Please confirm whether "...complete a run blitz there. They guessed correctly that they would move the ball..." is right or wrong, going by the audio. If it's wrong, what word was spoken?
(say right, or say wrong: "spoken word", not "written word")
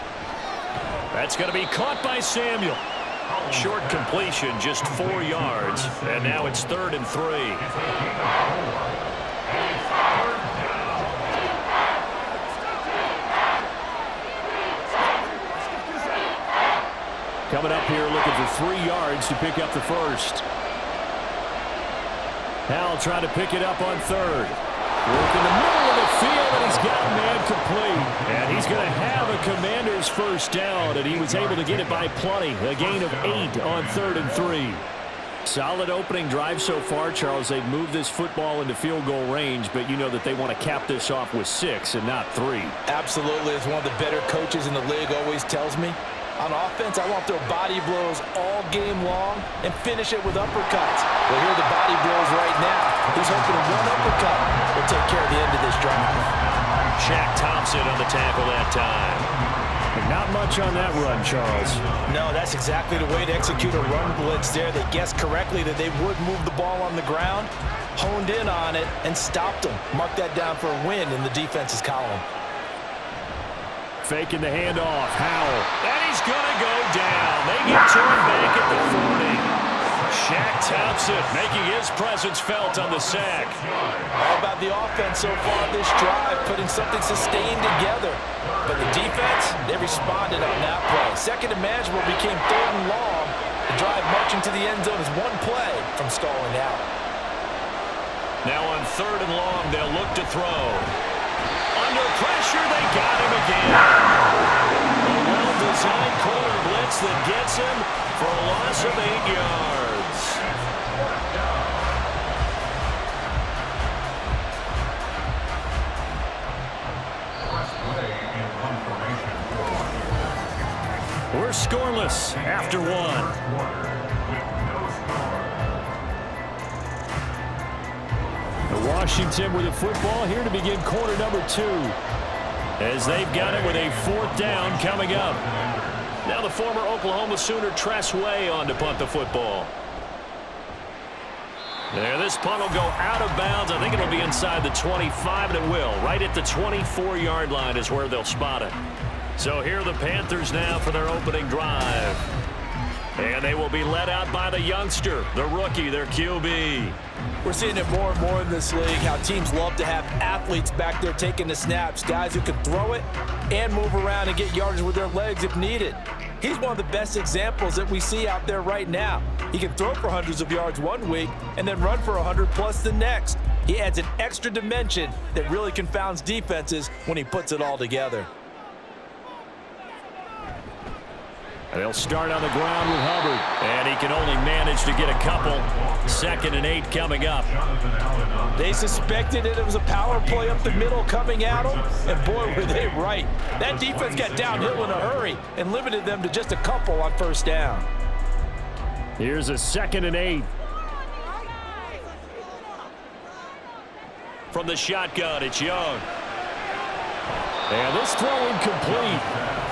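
wrong: "execute", not "complete".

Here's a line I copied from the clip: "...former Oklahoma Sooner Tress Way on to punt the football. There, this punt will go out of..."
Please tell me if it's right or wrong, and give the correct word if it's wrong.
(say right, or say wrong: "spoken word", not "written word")
right.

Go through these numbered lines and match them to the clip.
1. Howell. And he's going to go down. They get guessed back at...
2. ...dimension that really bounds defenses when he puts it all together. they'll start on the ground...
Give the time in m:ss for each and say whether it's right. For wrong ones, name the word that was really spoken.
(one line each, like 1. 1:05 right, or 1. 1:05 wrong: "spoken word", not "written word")
1. 1:15 wrong: "turned", not "guessed"
2. 2:54 wrong: "confounds", not "bounds".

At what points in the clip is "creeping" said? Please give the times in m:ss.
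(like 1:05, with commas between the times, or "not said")
not said.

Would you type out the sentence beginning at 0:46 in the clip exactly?
On offense, I want their throw body blows all game long and finish it with uppercuts.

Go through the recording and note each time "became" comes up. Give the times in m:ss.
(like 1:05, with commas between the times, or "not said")
1:32.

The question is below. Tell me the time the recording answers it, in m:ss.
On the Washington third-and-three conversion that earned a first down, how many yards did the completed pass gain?
0:32.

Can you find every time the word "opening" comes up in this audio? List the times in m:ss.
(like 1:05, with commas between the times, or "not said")
0:35, 2:31.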